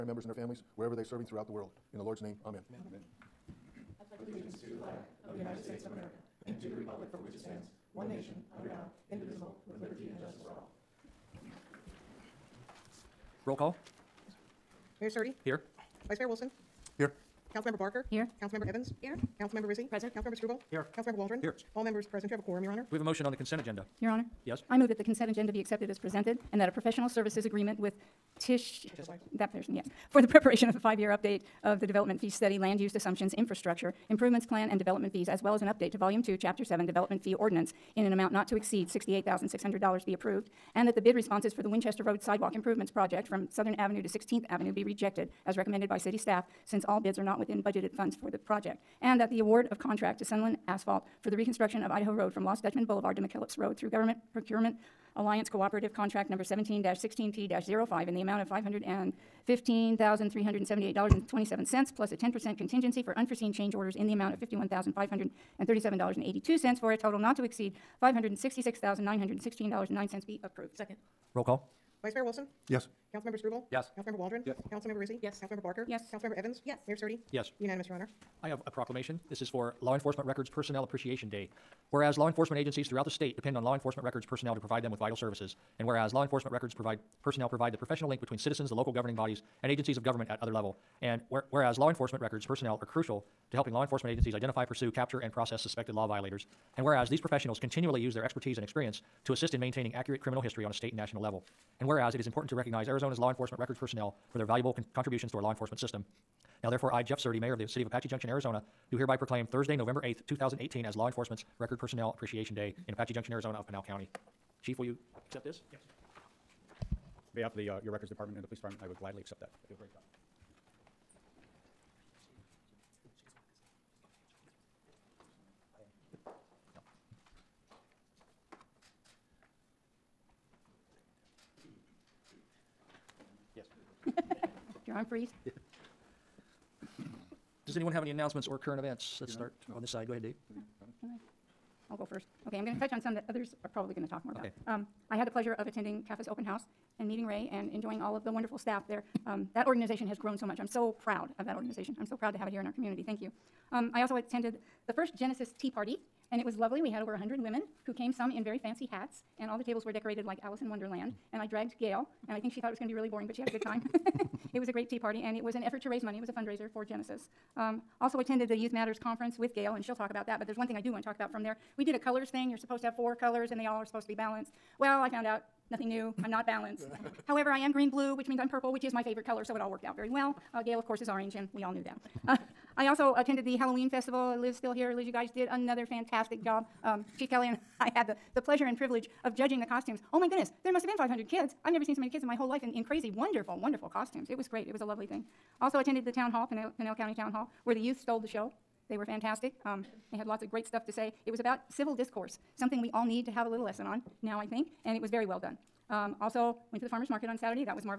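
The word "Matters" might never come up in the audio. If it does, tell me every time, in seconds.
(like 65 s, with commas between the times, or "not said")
168 s.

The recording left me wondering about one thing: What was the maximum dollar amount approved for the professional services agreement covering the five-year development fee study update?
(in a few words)
$68,600.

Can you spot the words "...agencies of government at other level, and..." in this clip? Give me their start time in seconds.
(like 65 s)
89 s.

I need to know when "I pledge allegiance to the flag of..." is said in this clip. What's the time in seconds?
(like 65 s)
4 s.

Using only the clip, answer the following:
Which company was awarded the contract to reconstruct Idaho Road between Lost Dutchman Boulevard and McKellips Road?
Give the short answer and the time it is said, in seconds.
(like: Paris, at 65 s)
Sunland Asphalt, at 50 s.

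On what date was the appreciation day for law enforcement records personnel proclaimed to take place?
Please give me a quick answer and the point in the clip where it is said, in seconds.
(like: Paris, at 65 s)
November 8th, 2018, at 109 s.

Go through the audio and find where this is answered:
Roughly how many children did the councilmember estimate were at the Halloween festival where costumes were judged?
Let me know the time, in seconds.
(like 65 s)
190 s.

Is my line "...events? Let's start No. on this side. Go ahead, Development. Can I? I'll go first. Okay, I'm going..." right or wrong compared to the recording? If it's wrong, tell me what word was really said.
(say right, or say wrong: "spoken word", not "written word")
wrong: "Dave", not "Development".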